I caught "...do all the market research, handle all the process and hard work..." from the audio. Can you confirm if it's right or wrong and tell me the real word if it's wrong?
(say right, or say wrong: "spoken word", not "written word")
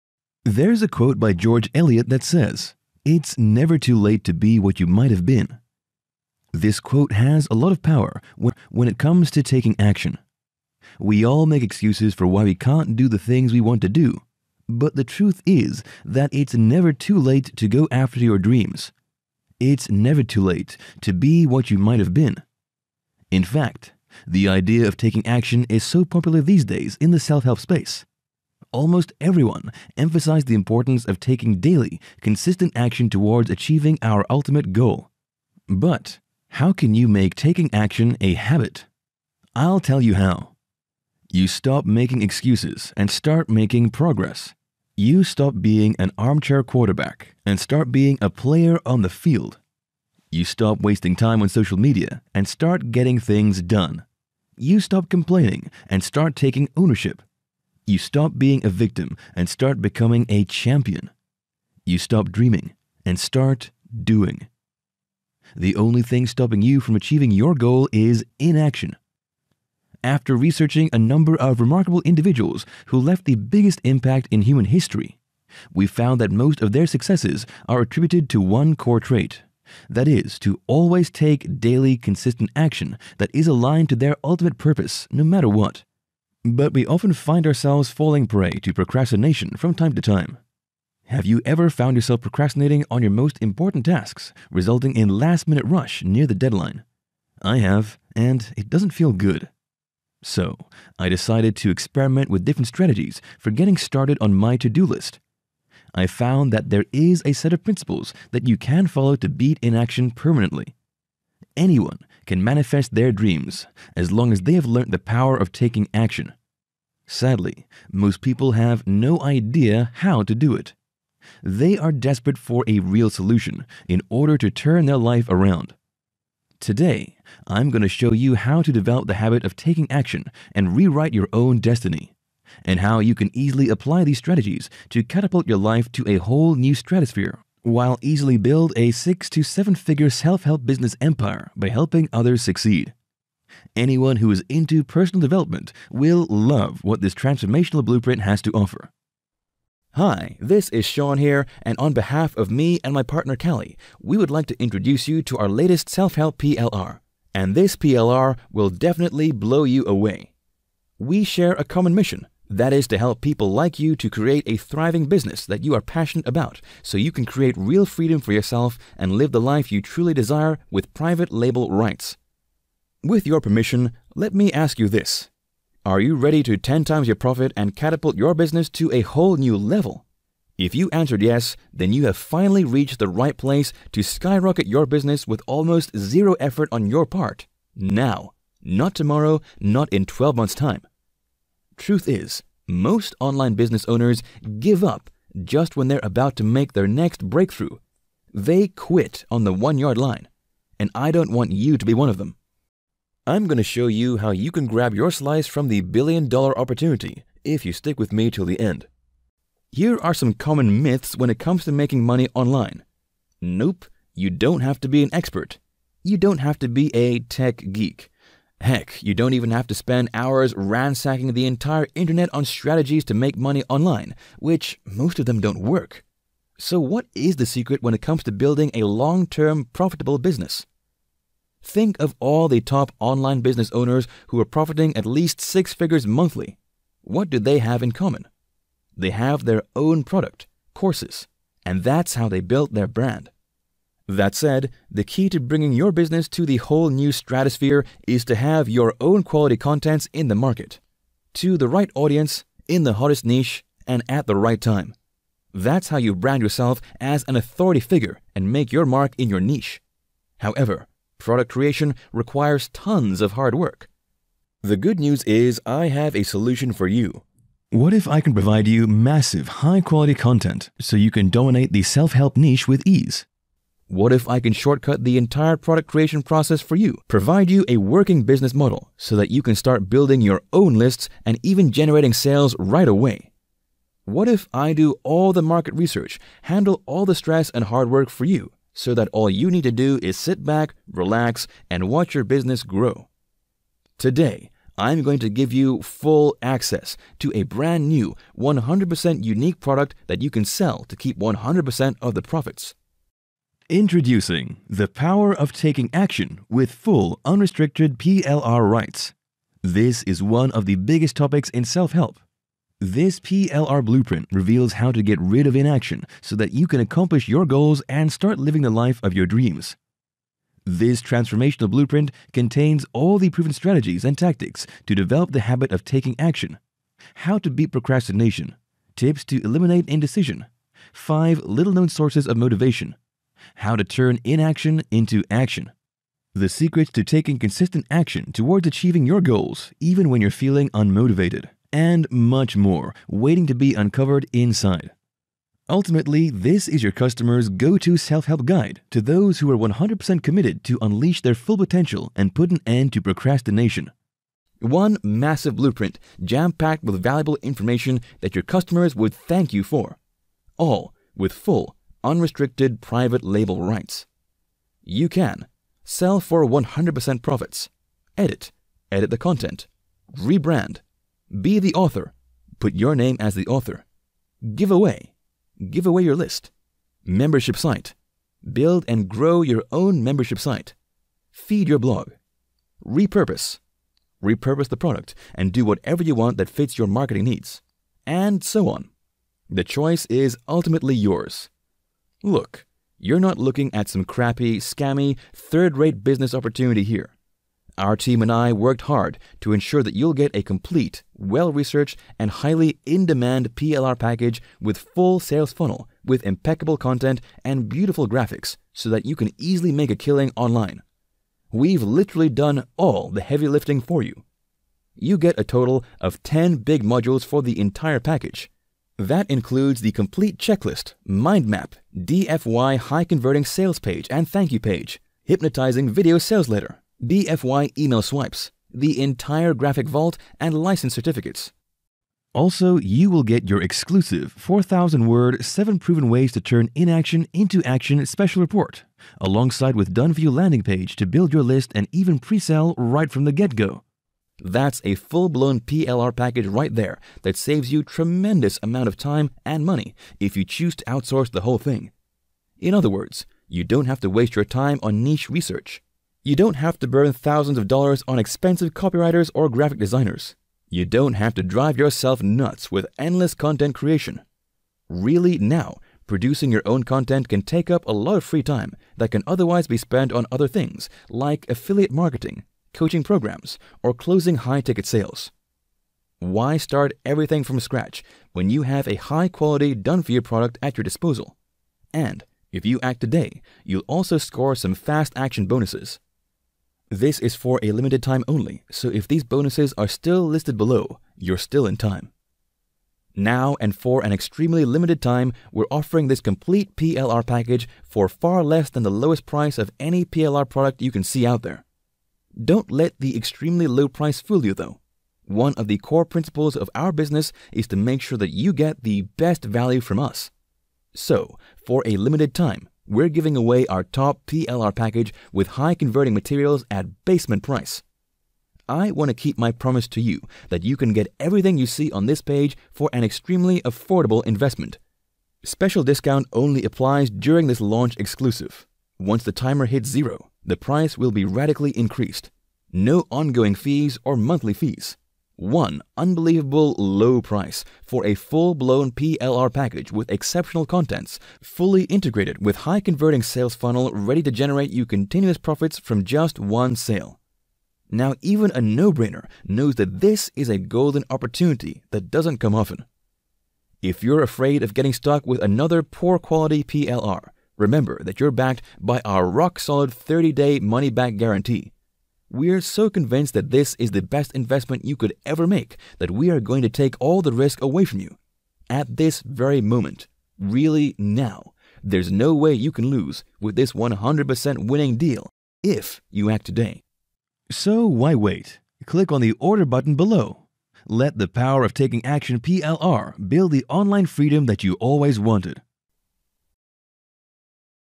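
wrong: "stress", not "process".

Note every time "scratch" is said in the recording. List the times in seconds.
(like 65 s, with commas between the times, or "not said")
477 s.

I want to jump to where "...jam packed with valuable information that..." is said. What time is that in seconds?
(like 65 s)
356 s.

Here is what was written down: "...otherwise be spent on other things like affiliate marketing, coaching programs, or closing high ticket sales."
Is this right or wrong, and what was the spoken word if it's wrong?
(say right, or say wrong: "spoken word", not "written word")
right.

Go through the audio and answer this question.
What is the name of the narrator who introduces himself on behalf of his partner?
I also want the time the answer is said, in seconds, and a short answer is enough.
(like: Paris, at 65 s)
Shaun, at 150 s.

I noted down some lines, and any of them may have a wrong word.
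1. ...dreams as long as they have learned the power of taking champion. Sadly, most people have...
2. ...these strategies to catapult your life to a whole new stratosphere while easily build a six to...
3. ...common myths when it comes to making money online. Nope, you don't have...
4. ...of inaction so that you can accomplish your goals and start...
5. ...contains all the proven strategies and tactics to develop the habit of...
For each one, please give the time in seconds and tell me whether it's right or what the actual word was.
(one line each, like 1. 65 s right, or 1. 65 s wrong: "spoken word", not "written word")
1. 113 s wrong: "action", not "champion"
2. 134 s right
3. 210 s right
4. 315 s right
5. 322 s right.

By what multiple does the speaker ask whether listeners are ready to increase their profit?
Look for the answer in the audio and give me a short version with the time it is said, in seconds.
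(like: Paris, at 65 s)
10 times, at 176 s.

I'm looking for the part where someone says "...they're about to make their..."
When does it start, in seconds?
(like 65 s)
195 s.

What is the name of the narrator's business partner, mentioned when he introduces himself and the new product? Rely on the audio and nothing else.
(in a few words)
Cally.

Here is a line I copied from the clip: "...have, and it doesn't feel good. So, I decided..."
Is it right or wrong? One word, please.
right.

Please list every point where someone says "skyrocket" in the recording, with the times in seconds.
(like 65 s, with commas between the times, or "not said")
184 s.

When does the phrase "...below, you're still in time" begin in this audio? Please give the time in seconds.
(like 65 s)
490 s.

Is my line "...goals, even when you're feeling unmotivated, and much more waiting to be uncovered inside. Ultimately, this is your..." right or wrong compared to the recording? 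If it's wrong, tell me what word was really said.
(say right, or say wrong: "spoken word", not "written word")
right.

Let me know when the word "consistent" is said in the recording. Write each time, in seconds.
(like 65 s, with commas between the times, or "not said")
32 s, 81 s, 337 s.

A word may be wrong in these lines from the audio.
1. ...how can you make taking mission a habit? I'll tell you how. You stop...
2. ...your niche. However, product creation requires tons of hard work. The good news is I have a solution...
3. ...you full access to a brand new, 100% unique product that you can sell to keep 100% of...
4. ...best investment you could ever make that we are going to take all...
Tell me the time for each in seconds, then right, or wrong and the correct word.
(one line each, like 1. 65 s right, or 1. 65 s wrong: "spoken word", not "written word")
1. 36 s wrong: "action", not "mission"
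2. 259 s right
3. 295 s right
4. 564 s right.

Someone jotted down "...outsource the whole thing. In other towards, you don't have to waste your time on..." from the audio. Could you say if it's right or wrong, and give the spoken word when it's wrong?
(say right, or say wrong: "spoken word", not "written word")
wrong: "words", not "towards".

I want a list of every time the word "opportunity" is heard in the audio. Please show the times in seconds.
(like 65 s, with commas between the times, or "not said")
206 s, 396 s, 551 s.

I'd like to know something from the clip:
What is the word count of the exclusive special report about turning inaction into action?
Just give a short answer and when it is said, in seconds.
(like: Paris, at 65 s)
4,000, at 434 s.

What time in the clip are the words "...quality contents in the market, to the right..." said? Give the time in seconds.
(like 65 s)
249 s.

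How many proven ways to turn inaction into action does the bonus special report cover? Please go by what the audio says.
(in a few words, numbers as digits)
7.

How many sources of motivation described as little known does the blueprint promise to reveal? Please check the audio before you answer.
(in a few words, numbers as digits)
5.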